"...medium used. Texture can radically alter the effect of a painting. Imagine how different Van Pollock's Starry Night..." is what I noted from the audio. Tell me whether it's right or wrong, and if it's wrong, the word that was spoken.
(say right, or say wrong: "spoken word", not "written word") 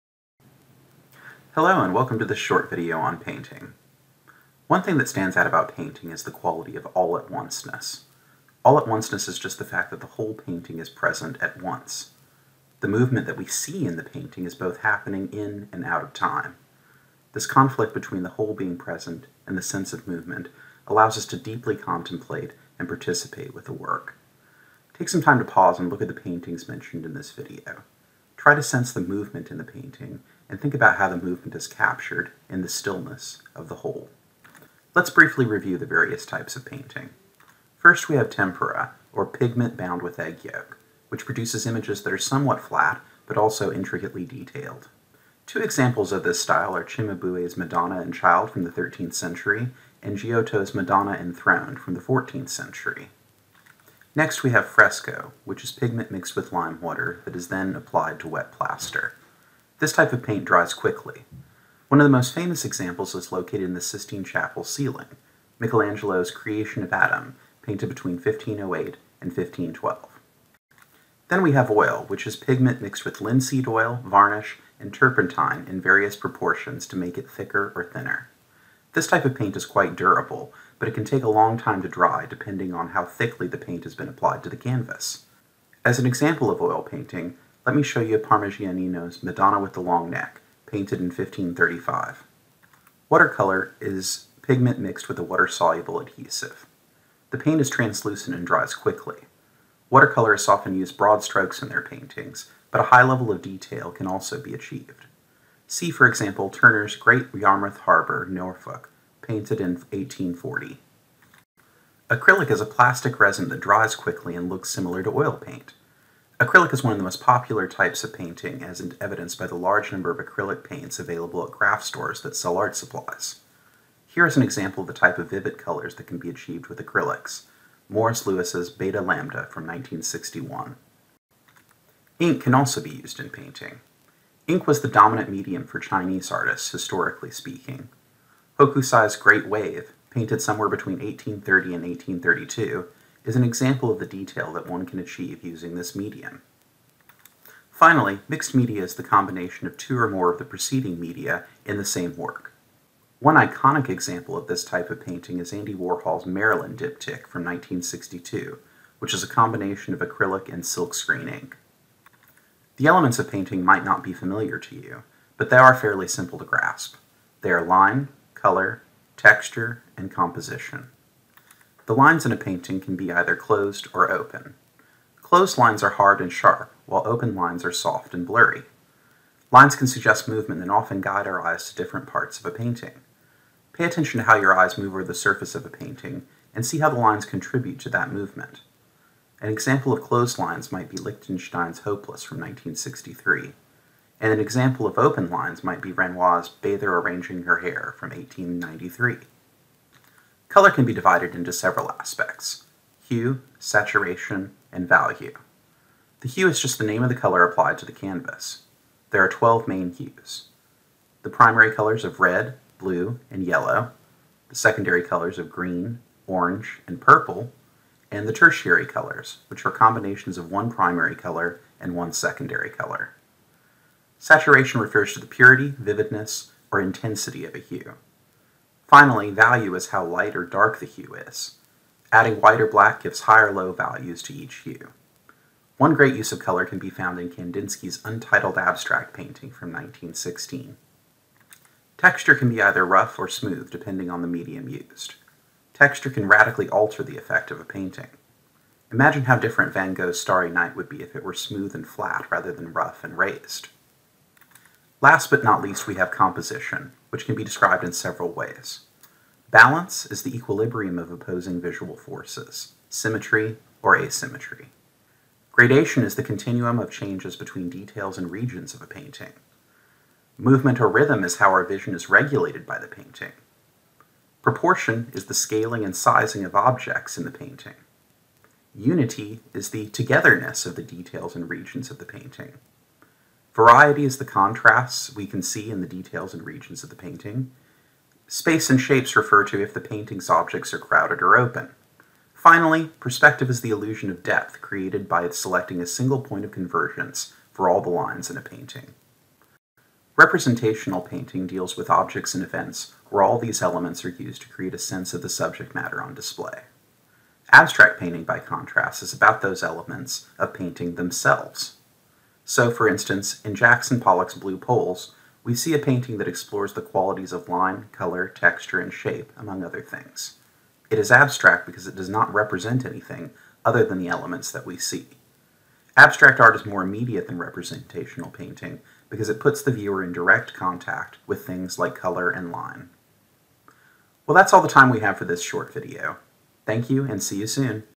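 wrong: "Gogh", not "Pollock".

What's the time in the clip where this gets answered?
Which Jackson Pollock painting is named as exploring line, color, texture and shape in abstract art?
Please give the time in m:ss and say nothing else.
5:14.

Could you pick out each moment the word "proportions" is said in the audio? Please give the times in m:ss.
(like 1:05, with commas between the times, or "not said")
1:16, 4:34.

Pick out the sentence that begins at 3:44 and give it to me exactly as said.
Saturation refers to the purity, vividness, or intensity of a hue.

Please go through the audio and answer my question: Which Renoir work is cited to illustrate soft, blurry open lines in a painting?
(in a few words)
Bather Arranging Her Hair.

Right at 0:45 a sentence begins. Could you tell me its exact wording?
Two examples of this style are Cimabue's Madonna and Child from the 13th century and Giotto's Madonna Enthroned from the 14th century.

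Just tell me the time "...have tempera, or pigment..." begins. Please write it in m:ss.
0:38.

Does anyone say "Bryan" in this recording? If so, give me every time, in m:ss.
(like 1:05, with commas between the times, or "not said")
not said.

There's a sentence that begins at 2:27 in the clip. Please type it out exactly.
Finally, mixed media is the combination of two or more of the preceding media in the same work.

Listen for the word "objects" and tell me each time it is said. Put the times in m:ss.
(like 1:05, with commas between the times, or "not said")
4:36, 4:50, 5:01.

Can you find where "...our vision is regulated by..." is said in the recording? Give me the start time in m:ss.
4:31.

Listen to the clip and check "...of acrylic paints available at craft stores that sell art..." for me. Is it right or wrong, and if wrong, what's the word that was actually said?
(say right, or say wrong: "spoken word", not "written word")
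right.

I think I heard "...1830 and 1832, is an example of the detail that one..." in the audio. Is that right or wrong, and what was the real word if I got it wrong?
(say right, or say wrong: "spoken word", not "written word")
right.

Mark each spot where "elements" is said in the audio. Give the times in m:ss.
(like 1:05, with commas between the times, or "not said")
2:42, 5:03, 5:09, 5:24.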